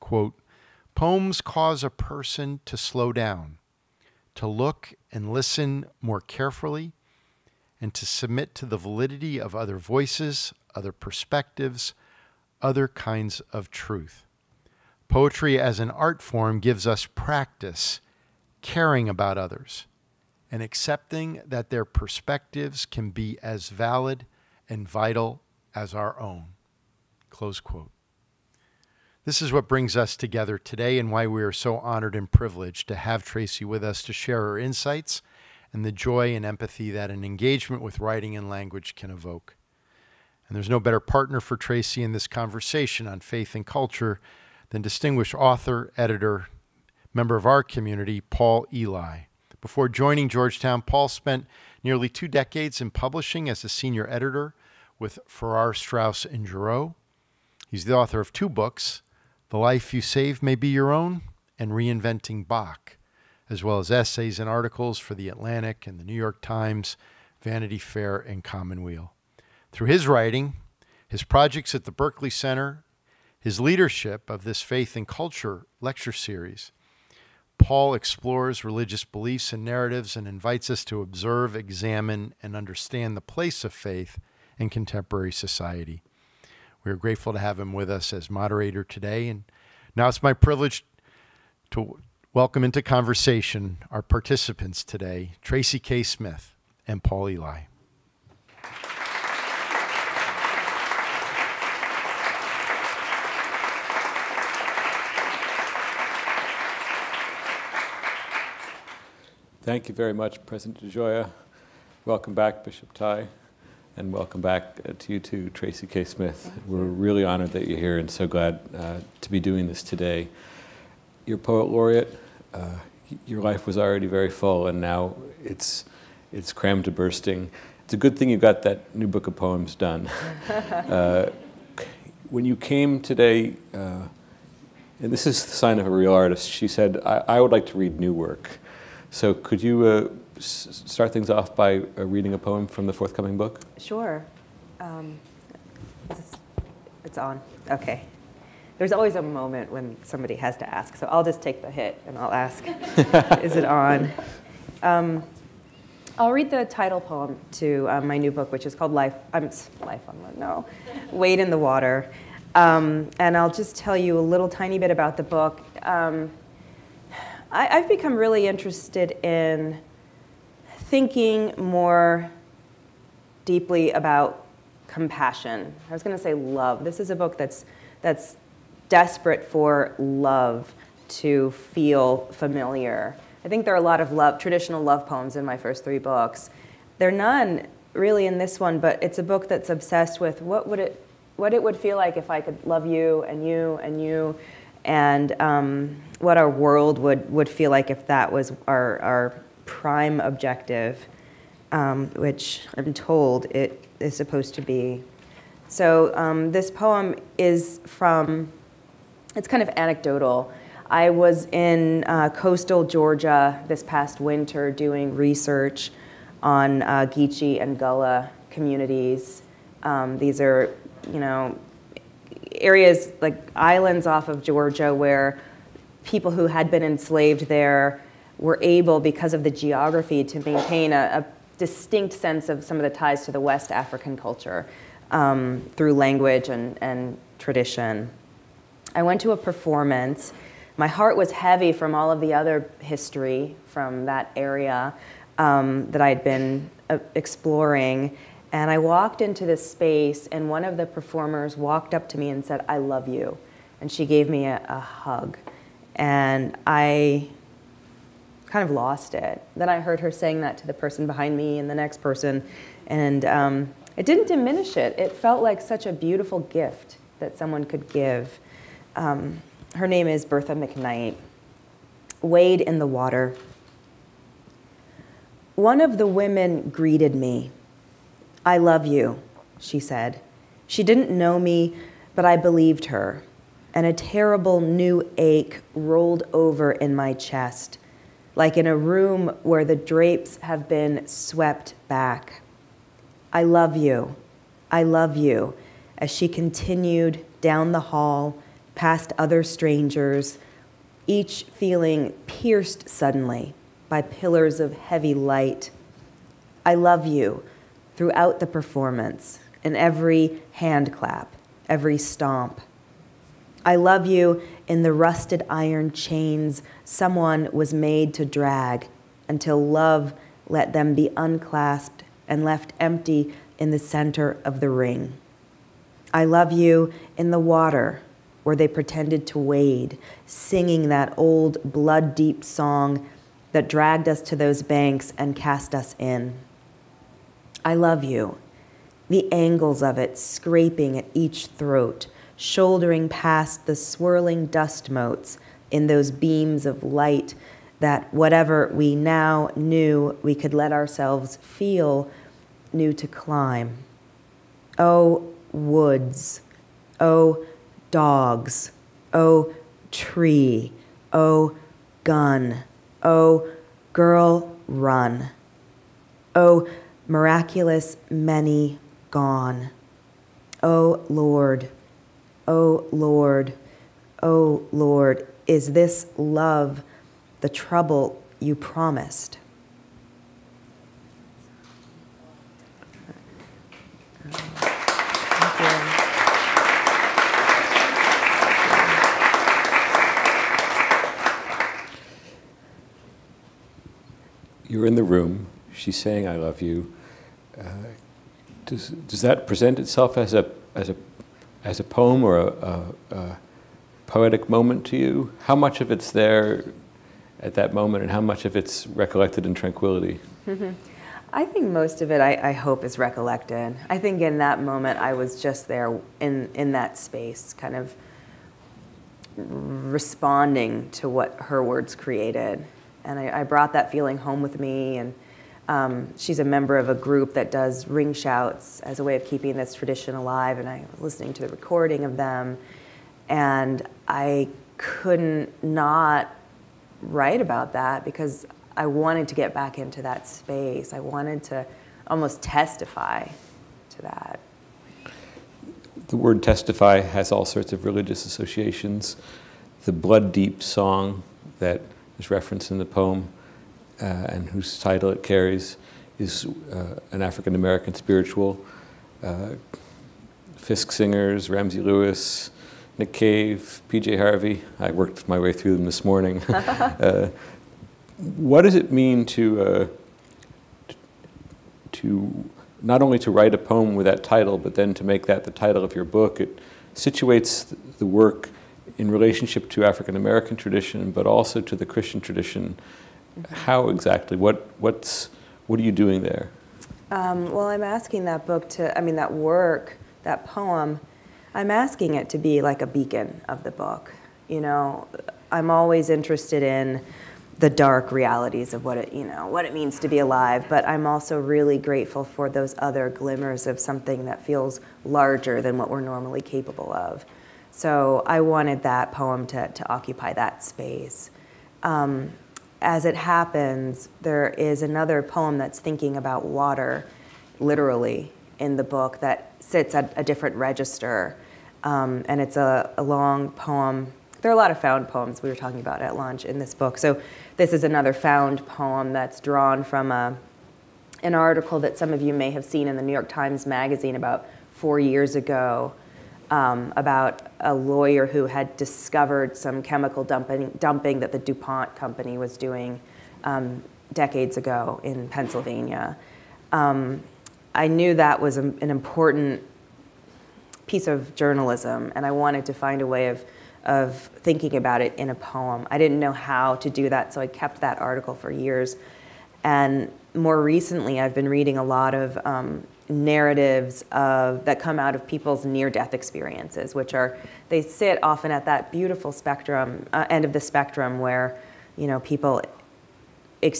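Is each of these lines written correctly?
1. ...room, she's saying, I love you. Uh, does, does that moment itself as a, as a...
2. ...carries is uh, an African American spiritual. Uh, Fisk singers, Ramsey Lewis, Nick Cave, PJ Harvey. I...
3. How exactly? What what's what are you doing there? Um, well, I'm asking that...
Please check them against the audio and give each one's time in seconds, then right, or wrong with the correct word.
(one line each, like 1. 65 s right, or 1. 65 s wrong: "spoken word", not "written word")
1. 395 s wrong: "present", not "moment"
2. 455 s right
3. 483 s right.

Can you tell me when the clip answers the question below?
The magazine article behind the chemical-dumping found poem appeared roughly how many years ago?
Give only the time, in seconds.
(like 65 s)
534 s.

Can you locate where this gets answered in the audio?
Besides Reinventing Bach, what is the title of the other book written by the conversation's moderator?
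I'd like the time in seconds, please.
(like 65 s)
59 s.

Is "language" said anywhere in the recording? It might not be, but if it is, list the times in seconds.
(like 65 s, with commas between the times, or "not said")
38 s, 235 s.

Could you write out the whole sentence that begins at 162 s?
Um, and I'll just tell you a little tiny bit about the book.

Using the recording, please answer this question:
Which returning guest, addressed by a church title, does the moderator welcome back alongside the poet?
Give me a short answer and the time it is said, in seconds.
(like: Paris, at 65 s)
Bishop Tighe, at 112 s.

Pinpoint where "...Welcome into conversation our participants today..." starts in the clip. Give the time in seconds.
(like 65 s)
92 s.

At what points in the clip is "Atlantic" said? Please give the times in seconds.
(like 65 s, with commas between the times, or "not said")
65 s.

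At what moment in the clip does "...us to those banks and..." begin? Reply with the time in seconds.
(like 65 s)
334 s.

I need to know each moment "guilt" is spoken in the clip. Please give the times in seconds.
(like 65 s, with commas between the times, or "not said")
not said.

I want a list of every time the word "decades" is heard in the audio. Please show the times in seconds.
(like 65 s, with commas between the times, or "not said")
52 s, 544 s.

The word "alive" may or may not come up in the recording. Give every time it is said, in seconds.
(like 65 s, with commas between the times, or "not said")
430 s, 500 s.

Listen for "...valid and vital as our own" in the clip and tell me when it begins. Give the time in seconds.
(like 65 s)
23 s.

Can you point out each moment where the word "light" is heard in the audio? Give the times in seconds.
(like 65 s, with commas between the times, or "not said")
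305 s, 346 s.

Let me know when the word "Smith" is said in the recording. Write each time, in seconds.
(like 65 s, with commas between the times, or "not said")
96 s, 116 s.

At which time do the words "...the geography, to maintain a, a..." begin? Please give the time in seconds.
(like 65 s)
229 s.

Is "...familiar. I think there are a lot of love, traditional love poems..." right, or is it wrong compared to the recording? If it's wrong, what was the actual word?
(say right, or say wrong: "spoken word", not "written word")
right.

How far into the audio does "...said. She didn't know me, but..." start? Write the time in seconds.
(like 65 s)
279 s.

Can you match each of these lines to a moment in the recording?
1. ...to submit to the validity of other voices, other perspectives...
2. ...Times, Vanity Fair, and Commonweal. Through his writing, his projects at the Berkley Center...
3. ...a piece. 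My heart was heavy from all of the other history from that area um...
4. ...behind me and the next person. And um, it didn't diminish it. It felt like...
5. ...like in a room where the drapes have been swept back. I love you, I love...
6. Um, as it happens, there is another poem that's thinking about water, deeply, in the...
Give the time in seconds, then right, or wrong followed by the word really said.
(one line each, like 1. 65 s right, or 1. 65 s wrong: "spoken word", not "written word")
1. 7 s right
2. 66 s right
3. 239 s wrong: "performance", not "piece"
4. 261 s right
5. 288 s right
6. 511 s wrong: "literally", not "deeply".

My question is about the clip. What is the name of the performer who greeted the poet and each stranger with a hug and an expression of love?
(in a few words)
Bertha McKnight.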